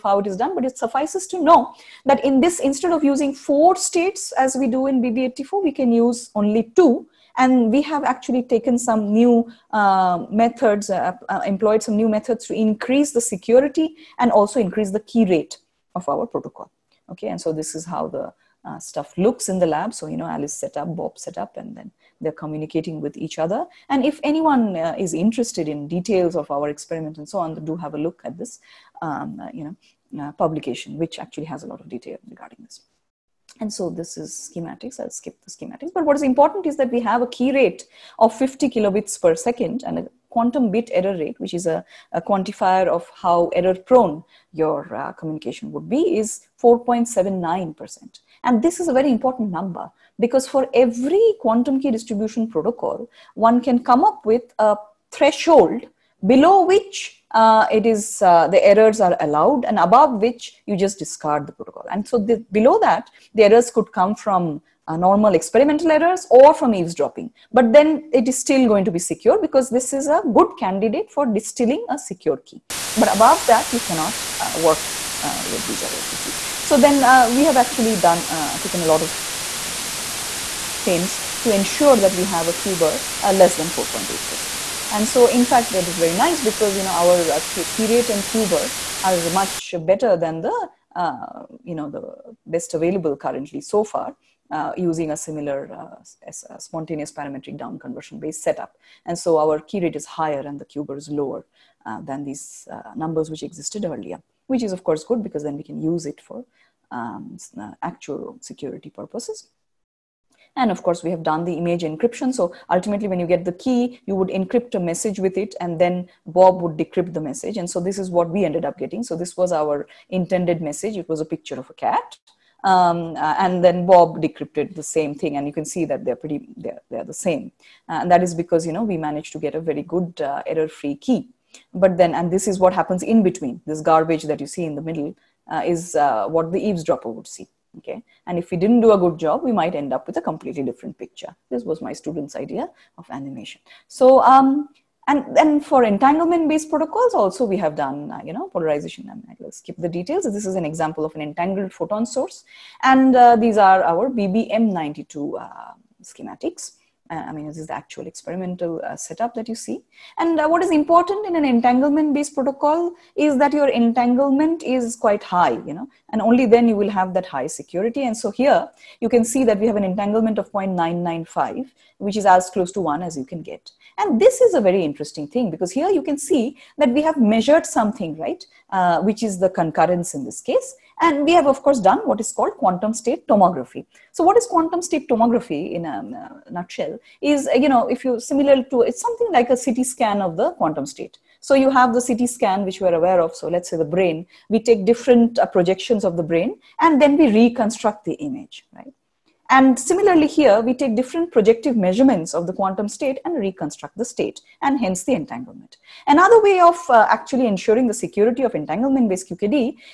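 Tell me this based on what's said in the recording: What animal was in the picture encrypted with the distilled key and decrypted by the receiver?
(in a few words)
A cat.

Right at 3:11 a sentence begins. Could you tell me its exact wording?
So you have the CT scan, which we're aware of.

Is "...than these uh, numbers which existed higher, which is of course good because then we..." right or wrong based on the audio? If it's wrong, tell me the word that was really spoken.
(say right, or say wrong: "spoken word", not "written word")
wrong: "earlier", not "higher".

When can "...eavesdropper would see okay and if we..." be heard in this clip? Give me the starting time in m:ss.
2:16.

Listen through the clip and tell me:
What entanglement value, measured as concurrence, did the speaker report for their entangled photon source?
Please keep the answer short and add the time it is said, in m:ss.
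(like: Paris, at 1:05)
0.995, at 2:50.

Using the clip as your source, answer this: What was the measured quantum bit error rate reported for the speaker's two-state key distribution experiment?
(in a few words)
4.79%.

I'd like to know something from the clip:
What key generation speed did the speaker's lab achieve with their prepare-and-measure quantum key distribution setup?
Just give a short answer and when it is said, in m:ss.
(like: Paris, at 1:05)
50 kilobits per second, at 0:38.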